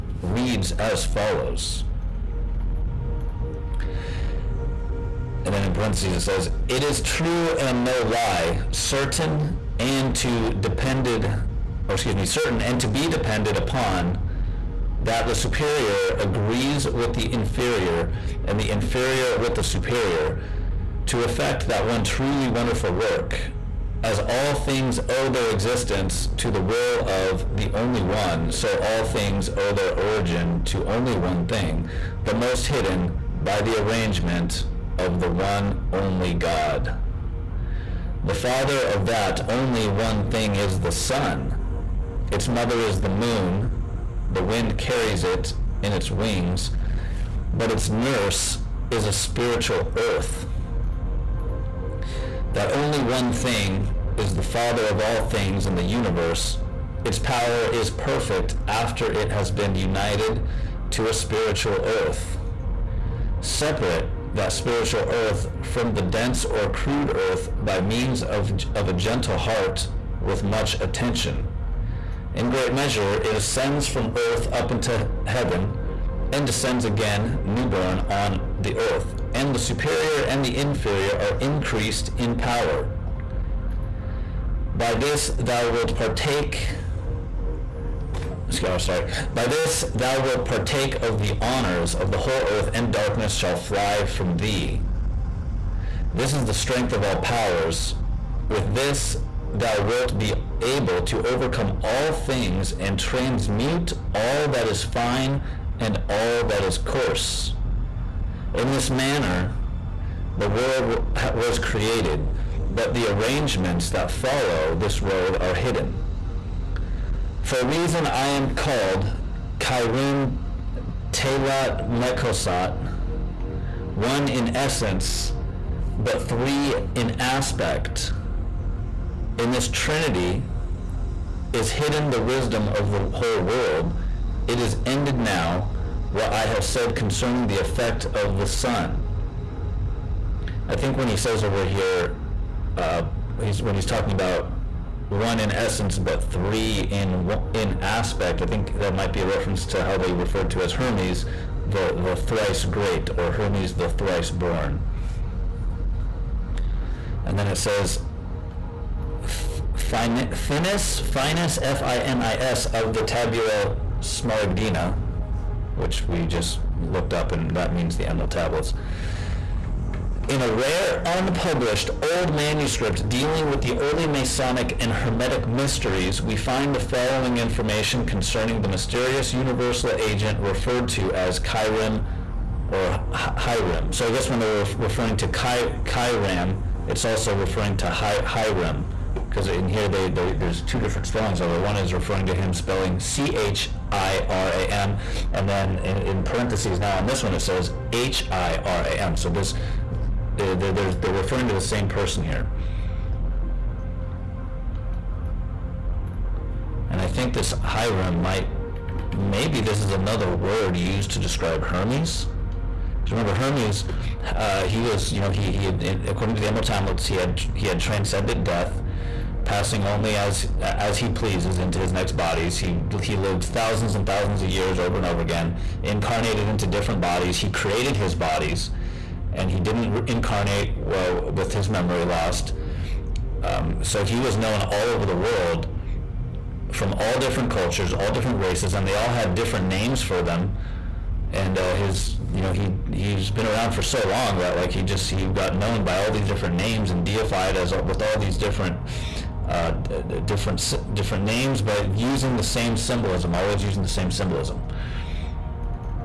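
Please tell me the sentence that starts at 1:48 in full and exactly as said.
In this manner, the world was created, but the arrangements that follow this road are hidden.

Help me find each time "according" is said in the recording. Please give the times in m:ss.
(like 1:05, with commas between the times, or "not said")
3:36.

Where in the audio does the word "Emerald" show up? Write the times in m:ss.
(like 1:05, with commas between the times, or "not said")
2:48, 3:36.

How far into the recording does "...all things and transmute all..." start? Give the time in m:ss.
1:41.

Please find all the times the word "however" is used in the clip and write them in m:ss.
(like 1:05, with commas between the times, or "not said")
not said.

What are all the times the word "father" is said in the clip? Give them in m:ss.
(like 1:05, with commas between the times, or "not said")
0:38, 0:54.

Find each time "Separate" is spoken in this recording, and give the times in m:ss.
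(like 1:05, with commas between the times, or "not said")
1:03.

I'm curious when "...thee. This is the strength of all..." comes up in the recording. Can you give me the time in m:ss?
1:34.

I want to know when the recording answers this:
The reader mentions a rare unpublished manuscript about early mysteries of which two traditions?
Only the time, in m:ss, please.
2:54.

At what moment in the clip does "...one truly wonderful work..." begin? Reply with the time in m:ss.
0:21.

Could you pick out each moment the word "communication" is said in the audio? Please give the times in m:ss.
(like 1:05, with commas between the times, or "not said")
not said.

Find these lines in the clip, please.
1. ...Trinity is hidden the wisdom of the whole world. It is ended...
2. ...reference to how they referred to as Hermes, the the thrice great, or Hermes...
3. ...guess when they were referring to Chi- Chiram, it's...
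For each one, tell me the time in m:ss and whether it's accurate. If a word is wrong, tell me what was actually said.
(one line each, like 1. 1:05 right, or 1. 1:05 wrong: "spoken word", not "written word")
1. 2:09 right
2. 2:29 right
3. 3:04 right.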